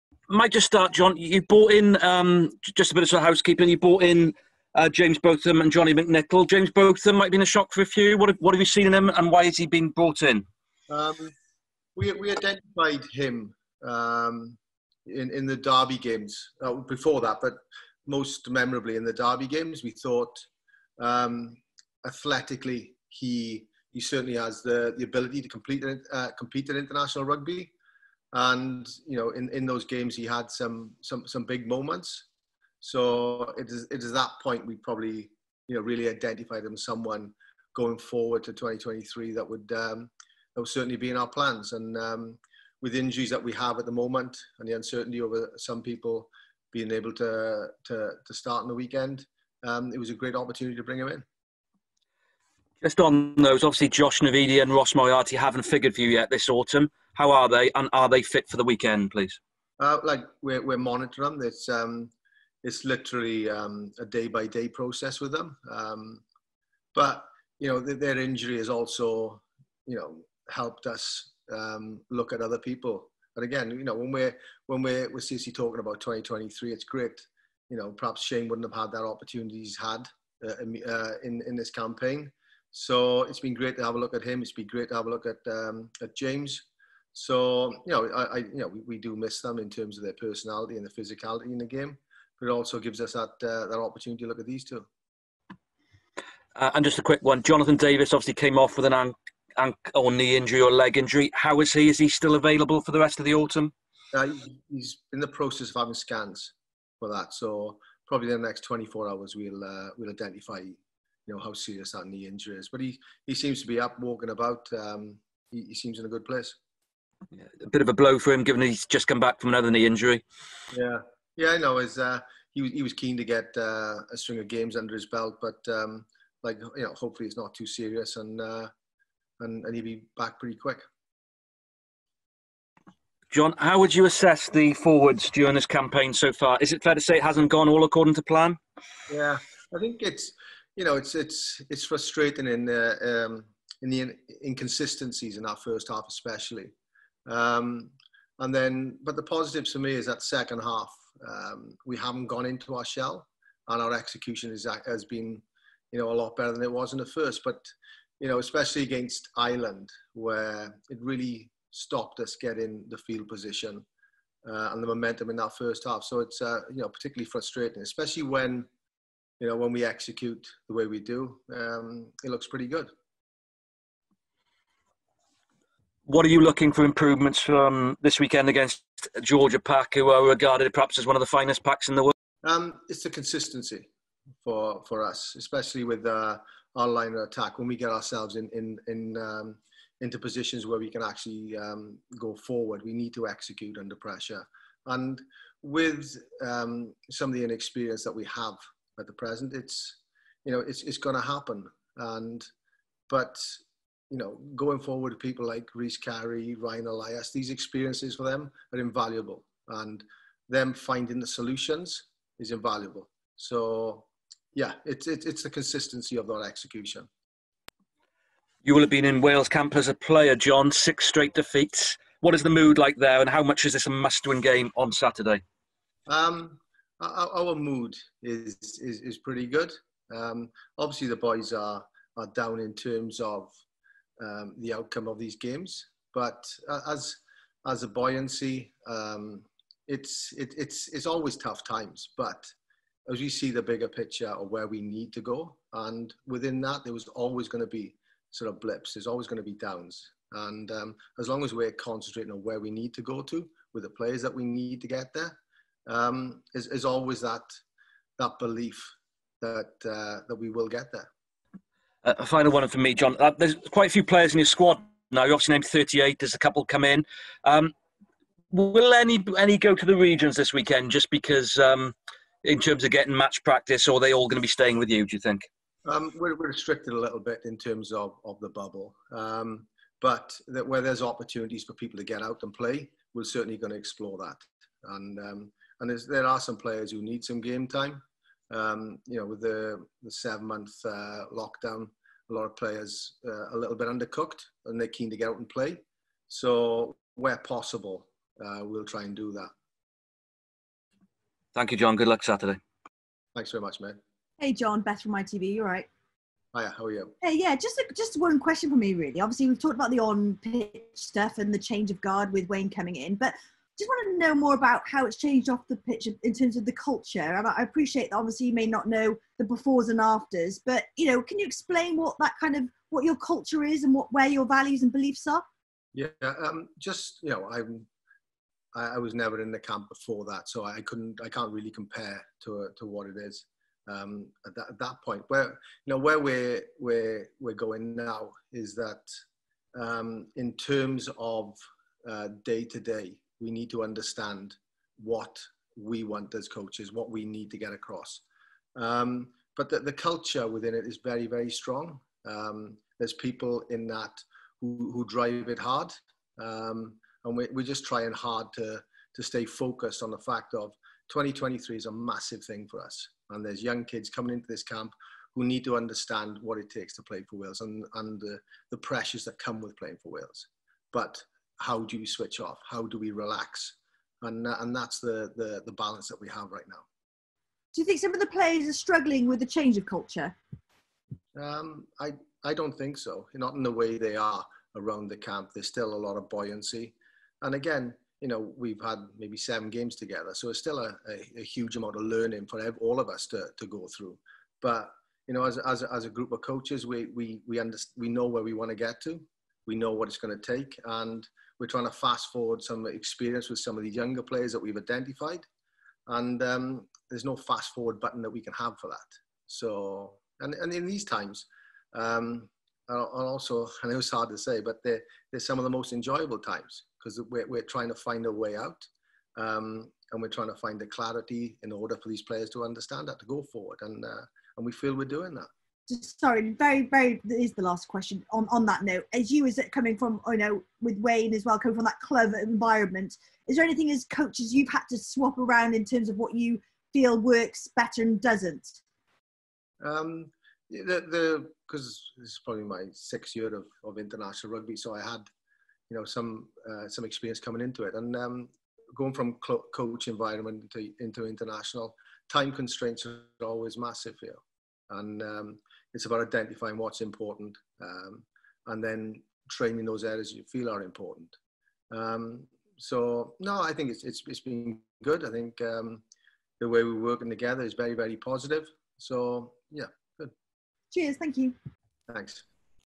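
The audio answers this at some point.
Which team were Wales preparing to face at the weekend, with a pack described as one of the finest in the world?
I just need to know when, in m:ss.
2:59.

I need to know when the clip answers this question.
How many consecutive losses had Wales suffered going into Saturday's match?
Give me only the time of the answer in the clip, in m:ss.
3:40.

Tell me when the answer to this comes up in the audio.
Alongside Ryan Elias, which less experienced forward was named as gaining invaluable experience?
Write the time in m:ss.
3:25.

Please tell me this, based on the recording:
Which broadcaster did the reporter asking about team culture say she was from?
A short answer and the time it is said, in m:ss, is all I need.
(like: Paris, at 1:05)
ITV, at 5:05.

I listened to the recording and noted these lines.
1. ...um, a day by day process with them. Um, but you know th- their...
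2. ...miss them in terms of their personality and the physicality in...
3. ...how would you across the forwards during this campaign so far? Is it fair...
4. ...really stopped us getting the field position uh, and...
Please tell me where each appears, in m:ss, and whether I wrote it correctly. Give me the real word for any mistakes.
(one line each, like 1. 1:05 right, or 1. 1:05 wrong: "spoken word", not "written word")
1. 1:03 right
2. 1:29 right
3. 2:13 wrong: "assess", not "across"
4. 2:41 right.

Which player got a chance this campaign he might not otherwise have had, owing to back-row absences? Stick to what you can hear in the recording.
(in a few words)
Shane.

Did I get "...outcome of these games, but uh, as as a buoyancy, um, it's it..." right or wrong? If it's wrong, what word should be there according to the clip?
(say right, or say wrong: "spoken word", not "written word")
right.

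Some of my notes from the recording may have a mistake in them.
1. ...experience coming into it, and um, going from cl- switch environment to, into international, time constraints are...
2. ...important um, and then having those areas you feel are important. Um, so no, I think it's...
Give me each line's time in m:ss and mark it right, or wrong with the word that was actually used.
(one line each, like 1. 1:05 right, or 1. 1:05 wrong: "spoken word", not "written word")
1. 7:27 wrong: "coach", not "switch"
2. 7:37 wrong: "training", not "having".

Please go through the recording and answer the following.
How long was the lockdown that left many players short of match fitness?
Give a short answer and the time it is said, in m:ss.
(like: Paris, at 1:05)
7 months, at 4:50.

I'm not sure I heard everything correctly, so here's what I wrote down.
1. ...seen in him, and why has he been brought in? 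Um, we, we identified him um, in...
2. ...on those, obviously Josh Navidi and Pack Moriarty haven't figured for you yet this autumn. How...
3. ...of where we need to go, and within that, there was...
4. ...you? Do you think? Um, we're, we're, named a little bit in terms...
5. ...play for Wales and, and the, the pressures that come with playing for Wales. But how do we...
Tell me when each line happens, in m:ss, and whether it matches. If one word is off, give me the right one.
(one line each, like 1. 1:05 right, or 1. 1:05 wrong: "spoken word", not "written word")
1. 0:08 right
2. 0:52 wrong: "Ross", not "Pack"
3. 4:04 right
4. 4:34 wrong: "restricted", not "named"
5. 6:07 right.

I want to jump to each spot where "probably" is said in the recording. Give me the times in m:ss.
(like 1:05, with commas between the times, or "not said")
0:34, 1:48, 7:22.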